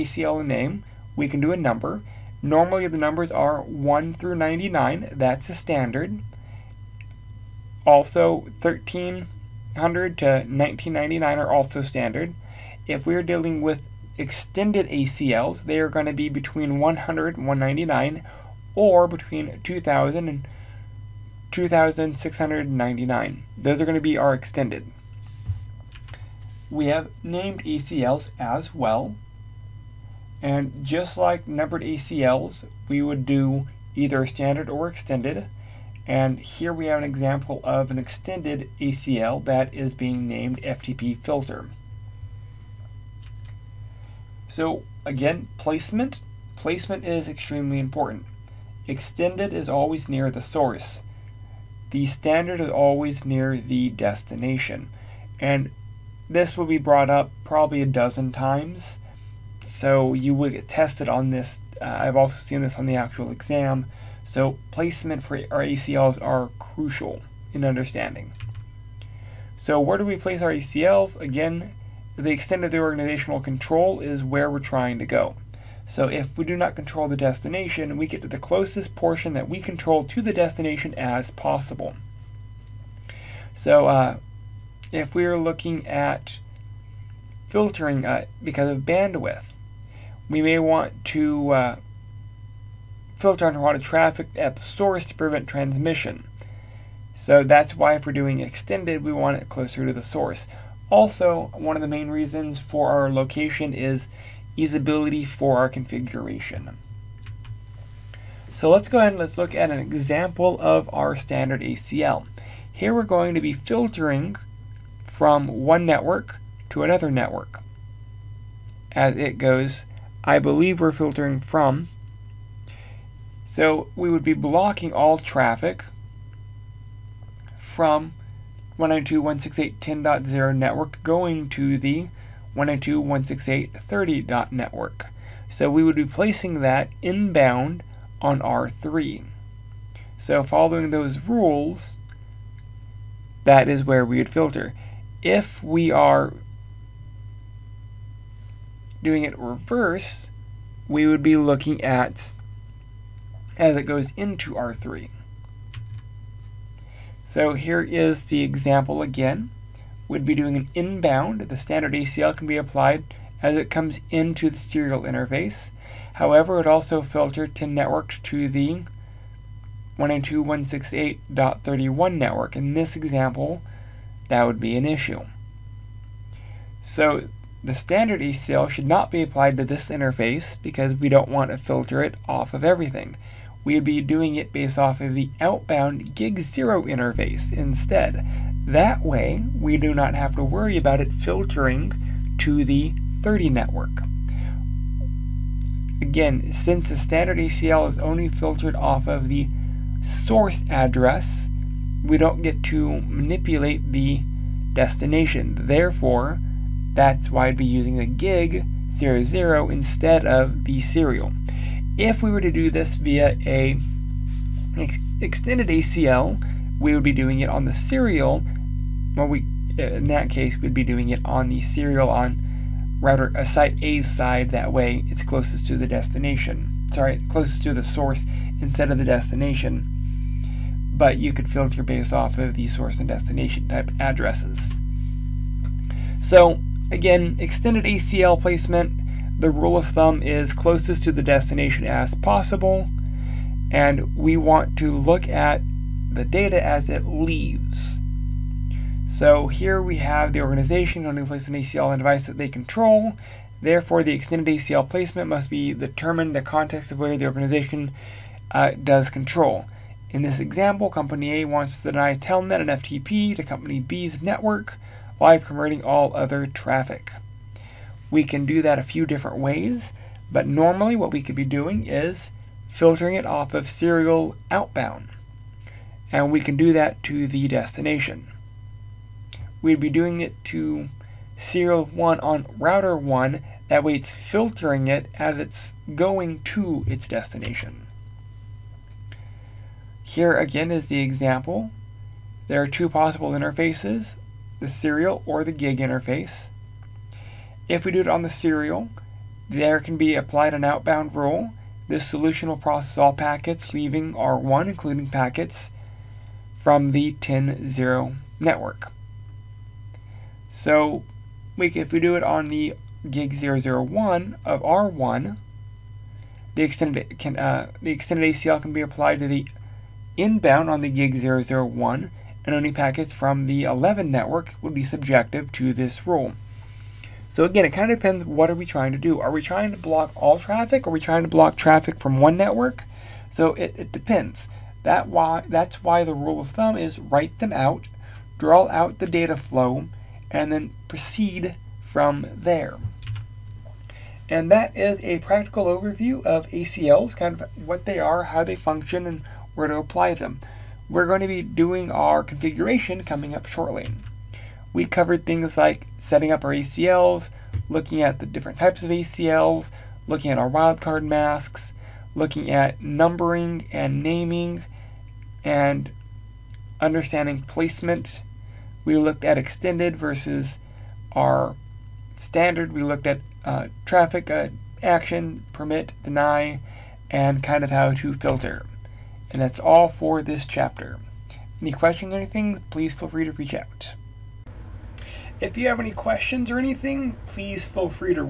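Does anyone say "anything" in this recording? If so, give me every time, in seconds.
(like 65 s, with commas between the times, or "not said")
382 s, 386 s.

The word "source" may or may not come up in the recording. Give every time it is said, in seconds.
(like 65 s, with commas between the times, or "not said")
50 s, 94 s, 100 s, 200 s, 227 s, 232 s.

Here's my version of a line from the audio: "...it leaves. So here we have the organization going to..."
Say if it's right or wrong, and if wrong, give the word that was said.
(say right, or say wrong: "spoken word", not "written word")
right.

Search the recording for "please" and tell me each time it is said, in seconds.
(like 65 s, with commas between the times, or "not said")
382 s, 387 s.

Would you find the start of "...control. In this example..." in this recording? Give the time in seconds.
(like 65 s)
259 s.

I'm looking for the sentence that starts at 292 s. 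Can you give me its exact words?
There are two possible interfaces, the serial or the gig interface.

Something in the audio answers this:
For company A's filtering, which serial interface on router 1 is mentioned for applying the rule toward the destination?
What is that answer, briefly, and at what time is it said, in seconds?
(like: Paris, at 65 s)
serial 1, at 281 s.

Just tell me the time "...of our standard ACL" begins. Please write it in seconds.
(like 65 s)
110 s.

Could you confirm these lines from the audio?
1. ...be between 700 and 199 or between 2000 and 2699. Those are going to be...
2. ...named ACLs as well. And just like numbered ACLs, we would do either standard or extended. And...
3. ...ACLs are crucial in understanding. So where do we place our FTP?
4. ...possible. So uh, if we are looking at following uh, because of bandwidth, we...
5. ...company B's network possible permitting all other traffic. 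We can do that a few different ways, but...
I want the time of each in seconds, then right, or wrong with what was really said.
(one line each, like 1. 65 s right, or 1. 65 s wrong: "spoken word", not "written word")
1. 16 s wrong: "100", not "700"
2. 27 s right
3. 65 s wrong: "ACLs", not "FTP"
4. 81 s wrong: "filtering", not "following"
5. 263 s wrong: "while", not "possible".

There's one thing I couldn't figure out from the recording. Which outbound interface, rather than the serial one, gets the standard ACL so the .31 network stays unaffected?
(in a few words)
gig zero.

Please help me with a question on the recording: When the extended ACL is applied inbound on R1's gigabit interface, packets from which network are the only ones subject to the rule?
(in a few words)
11 network.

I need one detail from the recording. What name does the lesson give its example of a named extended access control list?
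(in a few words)
FTP filter.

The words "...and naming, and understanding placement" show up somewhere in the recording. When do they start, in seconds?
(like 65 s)
363 s.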